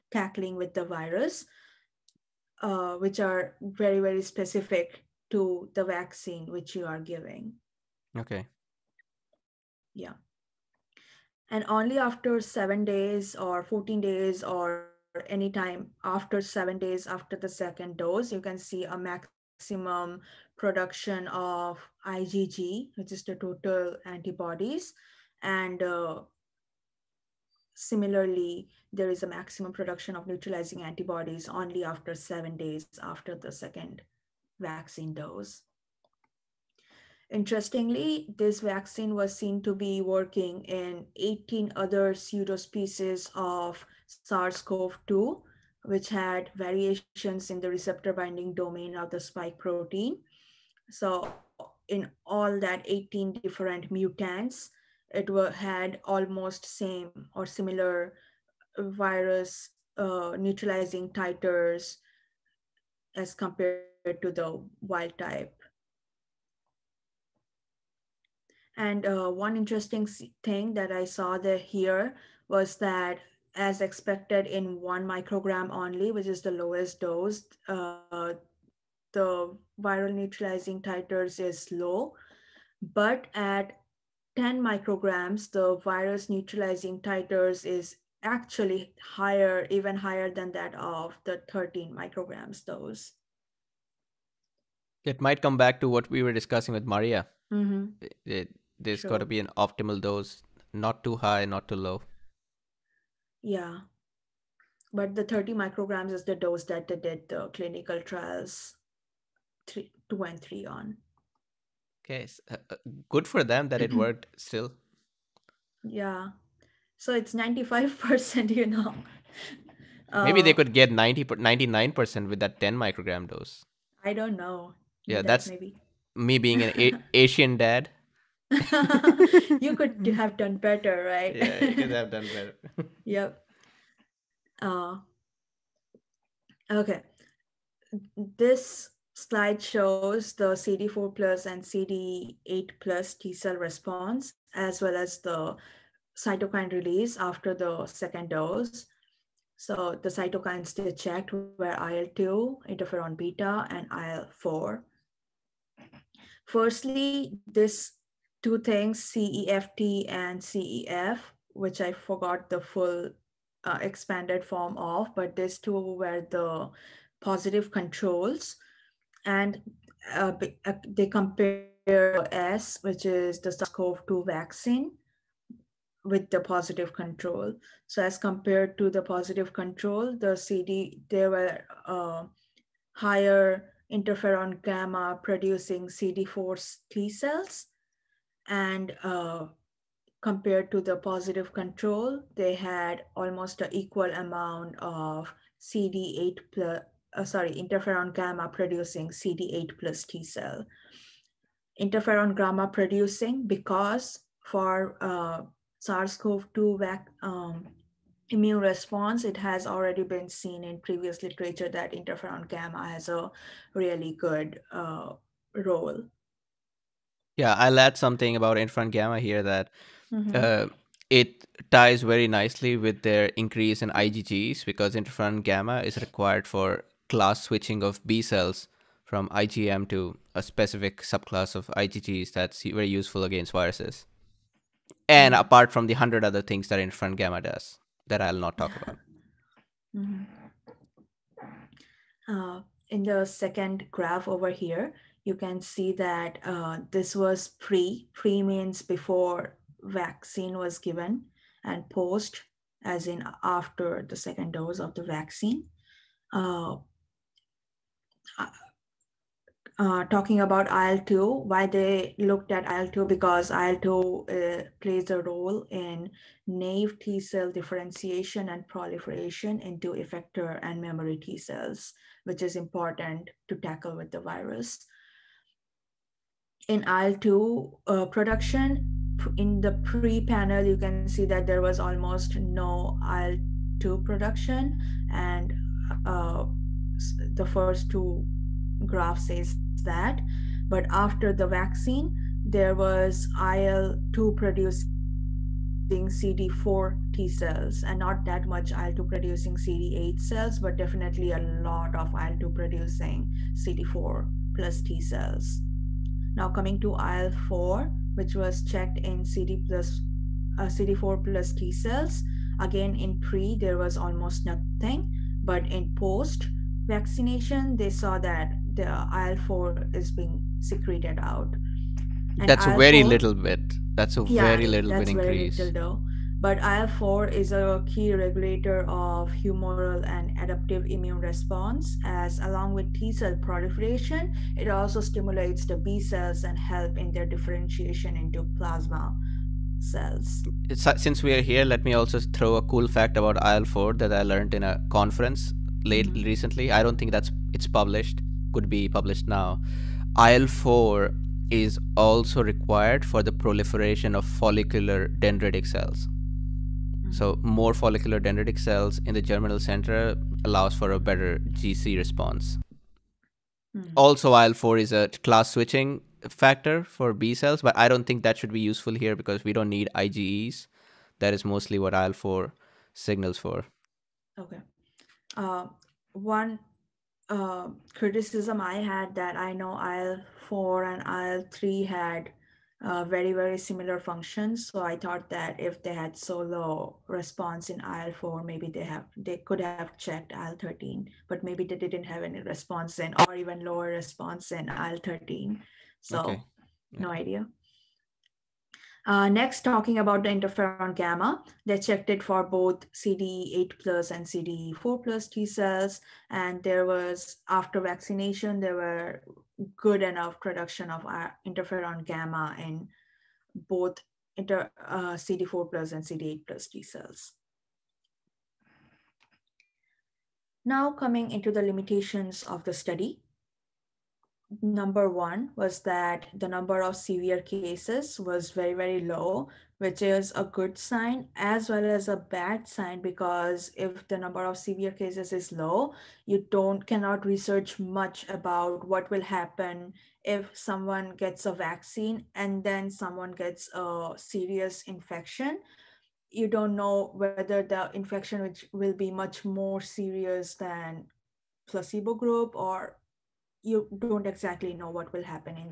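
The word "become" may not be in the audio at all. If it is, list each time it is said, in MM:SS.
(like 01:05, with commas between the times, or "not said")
not said.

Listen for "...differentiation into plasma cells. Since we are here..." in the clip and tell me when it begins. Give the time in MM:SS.
05:37.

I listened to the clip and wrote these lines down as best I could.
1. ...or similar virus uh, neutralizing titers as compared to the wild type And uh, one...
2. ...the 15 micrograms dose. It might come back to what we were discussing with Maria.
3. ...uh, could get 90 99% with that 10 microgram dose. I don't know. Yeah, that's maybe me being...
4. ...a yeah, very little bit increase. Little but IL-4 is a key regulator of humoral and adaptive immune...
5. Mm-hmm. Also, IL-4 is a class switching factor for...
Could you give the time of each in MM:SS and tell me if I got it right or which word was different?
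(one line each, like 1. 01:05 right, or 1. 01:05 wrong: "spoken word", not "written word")
1. 00:57 right
2. 01:31 wrong: "13", not "15"
3. 02:00 right
4. 05:24 right
5. 06:03 right.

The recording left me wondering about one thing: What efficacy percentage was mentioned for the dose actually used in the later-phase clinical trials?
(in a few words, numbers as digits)
95%.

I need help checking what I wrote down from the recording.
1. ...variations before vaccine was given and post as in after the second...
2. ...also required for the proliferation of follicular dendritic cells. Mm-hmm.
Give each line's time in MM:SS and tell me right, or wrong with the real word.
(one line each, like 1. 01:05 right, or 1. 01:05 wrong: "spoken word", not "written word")
1. 04:08 wrong: "means", not "variations"
2. 05:51 right.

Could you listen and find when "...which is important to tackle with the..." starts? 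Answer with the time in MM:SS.
04:32.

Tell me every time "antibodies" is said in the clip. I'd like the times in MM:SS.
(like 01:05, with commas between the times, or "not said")
00:24, 00:30.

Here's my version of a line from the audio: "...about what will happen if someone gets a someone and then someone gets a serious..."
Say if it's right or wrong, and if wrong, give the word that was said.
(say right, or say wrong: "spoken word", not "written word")
wrong: "vaccine", not "someone".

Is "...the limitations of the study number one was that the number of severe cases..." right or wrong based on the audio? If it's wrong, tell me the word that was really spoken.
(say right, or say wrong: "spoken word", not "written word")
right.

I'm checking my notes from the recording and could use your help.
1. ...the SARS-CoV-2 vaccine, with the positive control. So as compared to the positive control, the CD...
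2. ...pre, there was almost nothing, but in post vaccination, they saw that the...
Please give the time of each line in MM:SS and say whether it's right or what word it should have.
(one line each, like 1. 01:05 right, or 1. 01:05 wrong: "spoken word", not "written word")
1. 02:53 right
2. 05:13 right.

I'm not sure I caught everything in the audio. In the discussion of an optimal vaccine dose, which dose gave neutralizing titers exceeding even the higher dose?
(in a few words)
10 micrograms.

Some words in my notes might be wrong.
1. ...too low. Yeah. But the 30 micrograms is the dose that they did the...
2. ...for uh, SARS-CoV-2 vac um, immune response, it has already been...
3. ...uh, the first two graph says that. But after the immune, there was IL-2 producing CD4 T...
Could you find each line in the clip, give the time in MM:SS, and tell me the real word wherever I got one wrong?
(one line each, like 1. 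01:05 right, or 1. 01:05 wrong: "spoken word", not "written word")
1. 01:41 right
2. 03:24 right
3. 04:46 wrong: "vaccine", not "immune".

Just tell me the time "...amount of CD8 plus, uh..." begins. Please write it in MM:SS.
03:14.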